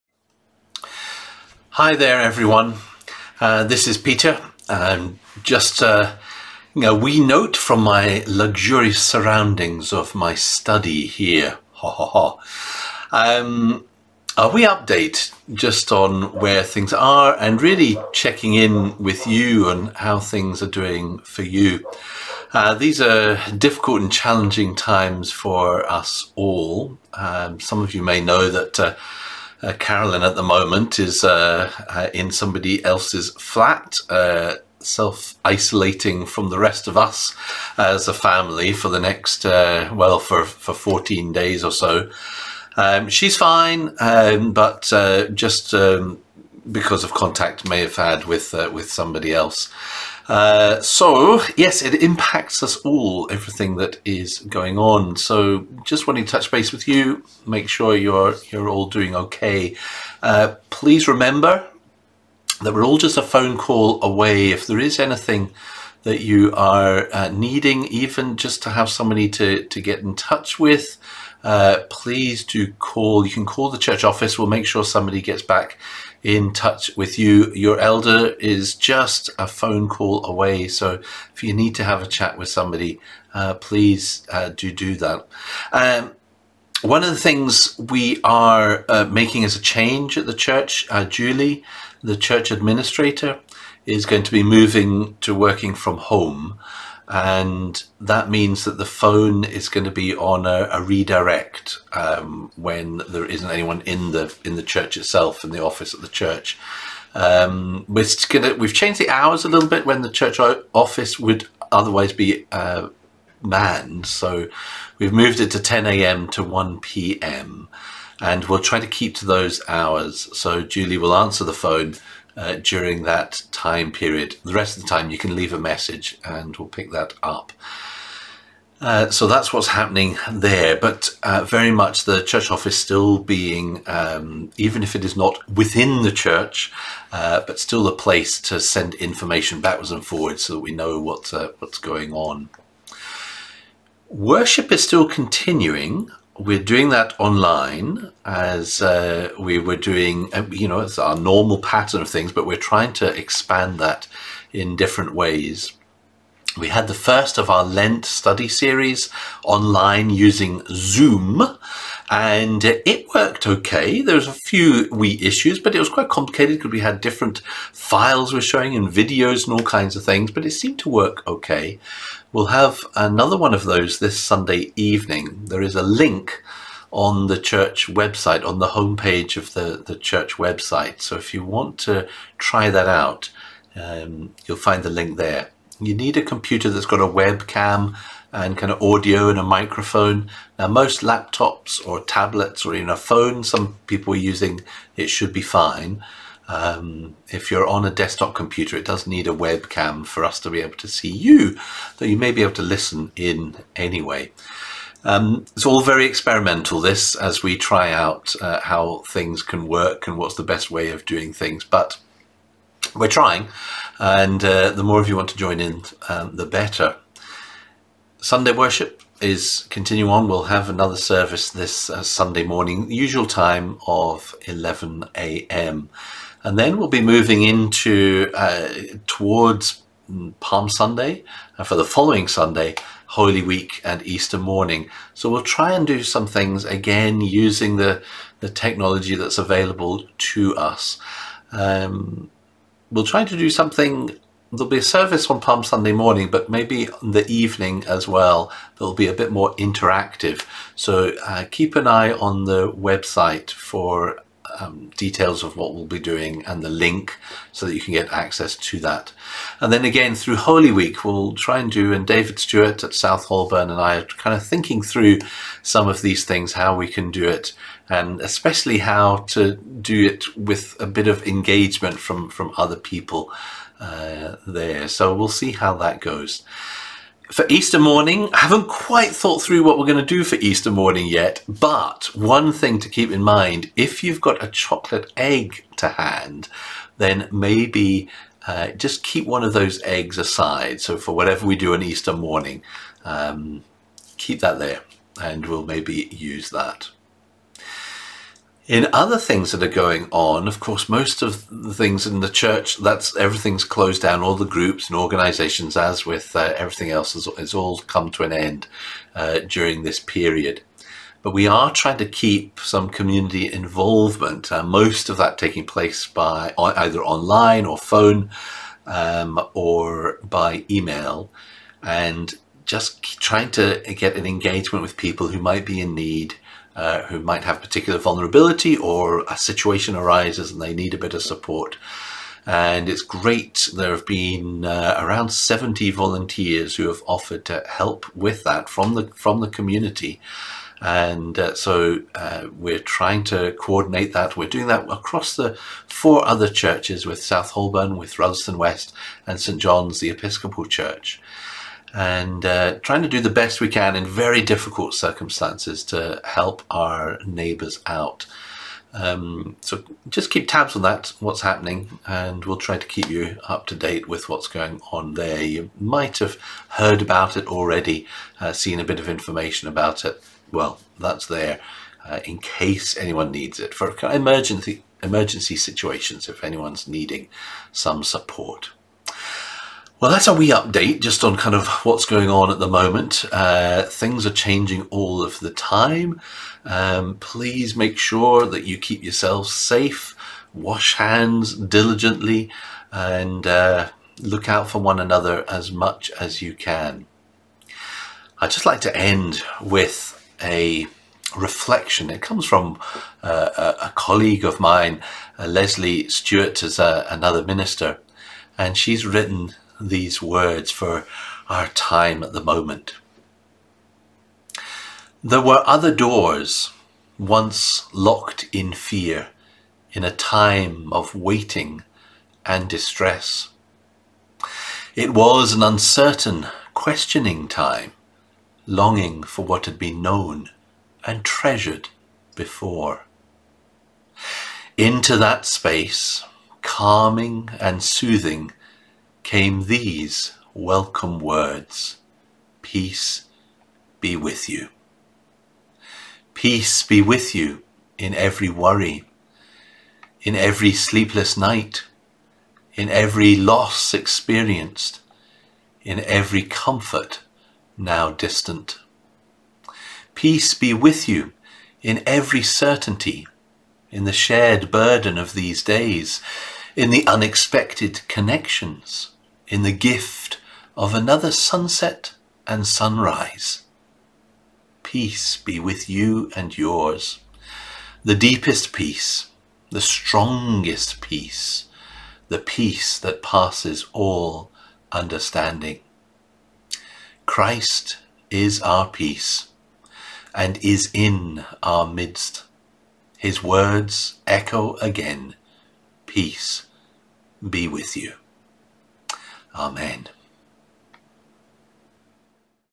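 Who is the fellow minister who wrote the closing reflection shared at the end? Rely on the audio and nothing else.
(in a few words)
Leslie Stewart.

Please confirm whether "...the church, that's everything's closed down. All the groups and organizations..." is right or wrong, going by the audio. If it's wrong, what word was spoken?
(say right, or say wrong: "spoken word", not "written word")
right.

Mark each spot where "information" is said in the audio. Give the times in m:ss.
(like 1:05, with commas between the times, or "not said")
2:18, 6:09.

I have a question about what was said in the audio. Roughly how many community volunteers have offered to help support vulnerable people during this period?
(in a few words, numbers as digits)
70.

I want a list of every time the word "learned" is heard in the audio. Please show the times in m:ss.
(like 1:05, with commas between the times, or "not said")
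not said.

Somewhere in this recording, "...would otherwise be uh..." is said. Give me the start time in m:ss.
1:51.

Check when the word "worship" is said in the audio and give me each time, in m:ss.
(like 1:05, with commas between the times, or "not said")
2:24, 3:38.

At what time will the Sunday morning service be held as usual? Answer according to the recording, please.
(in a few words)
11 a.m.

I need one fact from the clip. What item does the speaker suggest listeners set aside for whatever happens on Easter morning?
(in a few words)
A chocolate egg.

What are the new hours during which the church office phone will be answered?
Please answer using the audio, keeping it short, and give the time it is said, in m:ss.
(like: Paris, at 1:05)
10 a.m. to 1 p.m., at 1:55.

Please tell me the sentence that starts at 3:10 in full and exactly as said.
Now, most laptops or tablets or even a phone, some people are using, it should be fine.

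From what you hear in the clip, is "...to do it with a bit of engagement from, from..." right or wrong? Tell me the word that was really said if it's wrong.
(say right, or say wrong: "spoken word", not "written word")
right.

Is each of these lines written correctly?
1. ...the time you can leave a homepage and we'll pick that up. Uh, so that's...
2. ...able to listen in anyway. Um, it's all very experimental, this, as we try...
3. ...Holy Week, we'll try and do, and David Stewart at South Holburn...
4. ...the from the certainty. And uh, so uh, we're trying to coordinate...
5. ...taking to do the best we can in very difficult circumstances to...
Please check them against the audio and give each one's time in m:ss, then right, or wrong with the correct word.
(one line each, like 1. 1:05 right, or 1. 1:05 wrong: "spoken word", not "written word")
1. 2:04 wrong: "message", not "homepage"
2. 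3:22 right
3. 4:20 right
4. 5:38 wrong: "community", not "certainty"
5. 5:52 wrong: "trying", not "taking".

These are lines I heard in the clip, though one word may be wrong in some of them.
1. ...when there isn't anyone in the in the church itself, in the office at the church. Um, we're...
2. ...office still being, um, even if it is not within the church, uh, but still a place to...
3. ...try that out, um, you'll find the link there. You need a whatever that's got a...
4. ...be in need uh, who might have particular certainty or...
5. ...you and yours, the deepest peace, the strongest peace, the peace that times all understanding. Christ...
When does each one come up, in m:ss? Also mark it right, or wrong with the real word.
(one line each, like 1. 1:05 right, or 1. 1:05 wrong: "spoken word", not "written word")
1. 1:42 right
2. 2:12 right
3. 3:02 wrong: "computer", not "whatever"
4. 5:25 wrong: "vulnerability", not "certainty"
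5. 7:55 wrong: "passes", not "times".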